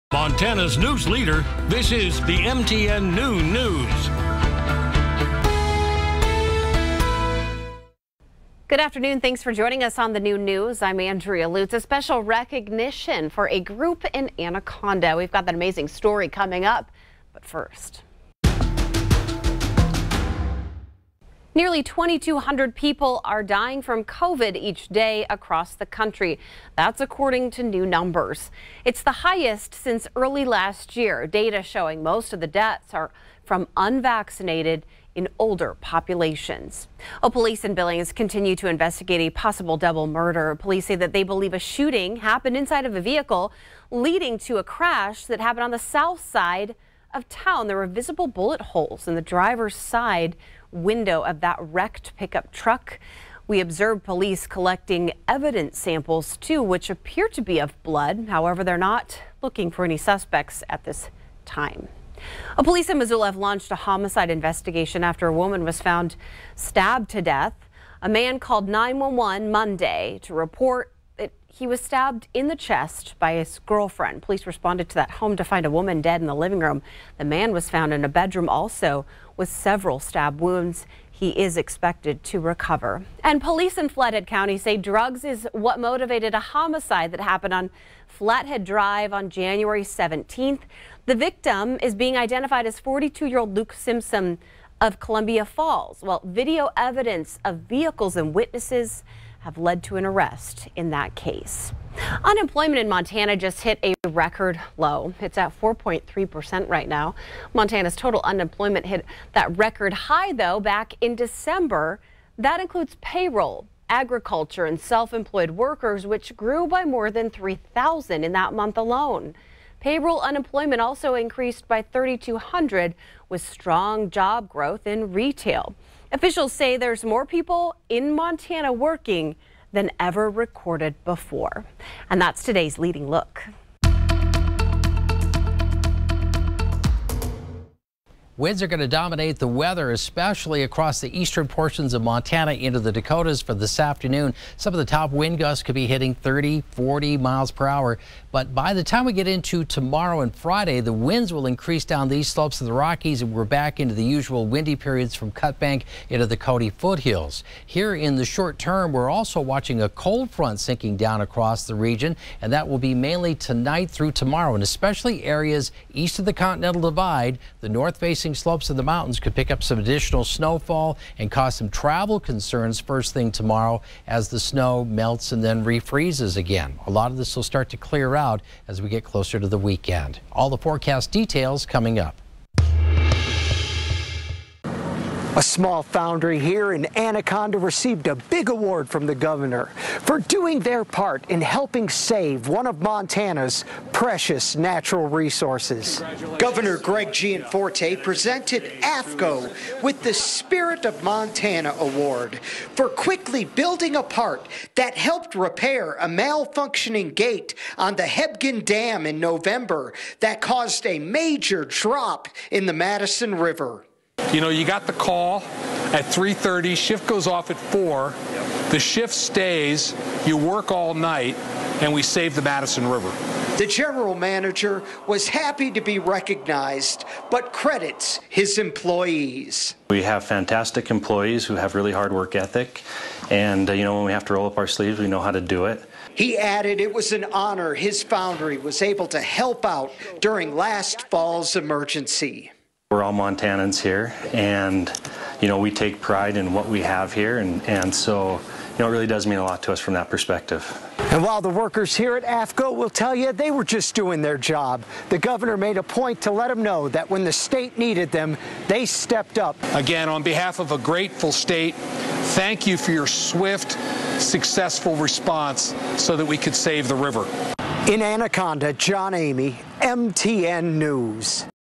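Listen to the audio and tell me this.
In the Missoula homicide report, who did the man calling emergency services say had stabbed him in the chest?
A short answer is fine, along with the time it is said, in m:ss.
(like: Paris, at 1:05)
His girlfriend, at 1:13.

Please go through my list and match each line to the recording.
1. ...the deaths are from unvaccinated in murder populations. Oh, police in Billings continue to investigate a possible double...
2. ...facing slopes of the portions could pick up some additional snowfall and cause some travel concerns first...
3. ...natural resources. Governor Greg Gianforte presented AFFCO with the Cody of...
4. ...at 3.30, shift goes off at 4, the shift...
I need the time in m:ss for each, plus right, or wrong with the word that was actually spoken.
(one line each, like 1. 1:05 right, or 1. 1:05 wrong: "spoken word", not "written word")
1. 0:32 wrong: "older", not "murder"
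2. 2:47 wrong: "mountains", not "portions"
3. 3:14 wrong: "Spirit", not "Cody"
4. 3:35 right.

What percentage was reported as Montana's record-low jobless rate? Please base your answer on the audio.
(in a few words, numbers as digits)
4.3%.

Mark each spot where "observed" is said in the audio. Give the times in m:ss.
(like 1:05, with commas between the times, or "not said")
0:53.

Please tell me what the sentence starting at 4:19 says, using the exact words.
Again, on behalf of a grateful state, thank you for your swift, successful response so that we could save the river.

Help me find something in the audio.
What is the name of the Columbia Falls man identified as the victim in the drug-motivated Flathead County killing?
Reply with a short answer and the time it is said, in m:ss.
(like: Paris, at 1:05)
Luke Simpson, at 1:33.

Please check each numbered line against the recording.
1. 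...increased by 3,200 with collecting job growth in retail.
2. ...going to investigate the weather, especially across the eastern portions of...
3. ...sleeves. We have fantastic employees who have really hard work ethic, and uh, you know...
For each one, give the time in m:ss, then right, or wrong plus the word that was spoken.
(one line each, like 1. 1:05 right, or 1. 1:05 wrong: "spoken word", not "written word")
1. 2:01 wrong: "strong", not "collecting"
2. 2:18 wrong: "dominate", not "investigate"
3. 3:48 wrong: "employees", not "sleeves".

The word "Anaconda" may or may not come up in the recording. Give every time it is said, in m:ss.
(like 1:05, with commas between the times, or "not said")
0:14, 3:06, 4:28.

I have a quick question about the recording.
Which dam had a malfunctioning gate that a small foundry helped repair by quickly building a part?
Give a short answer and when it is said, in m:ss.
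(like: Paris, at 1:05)
Hebgen Dam, at 3:28.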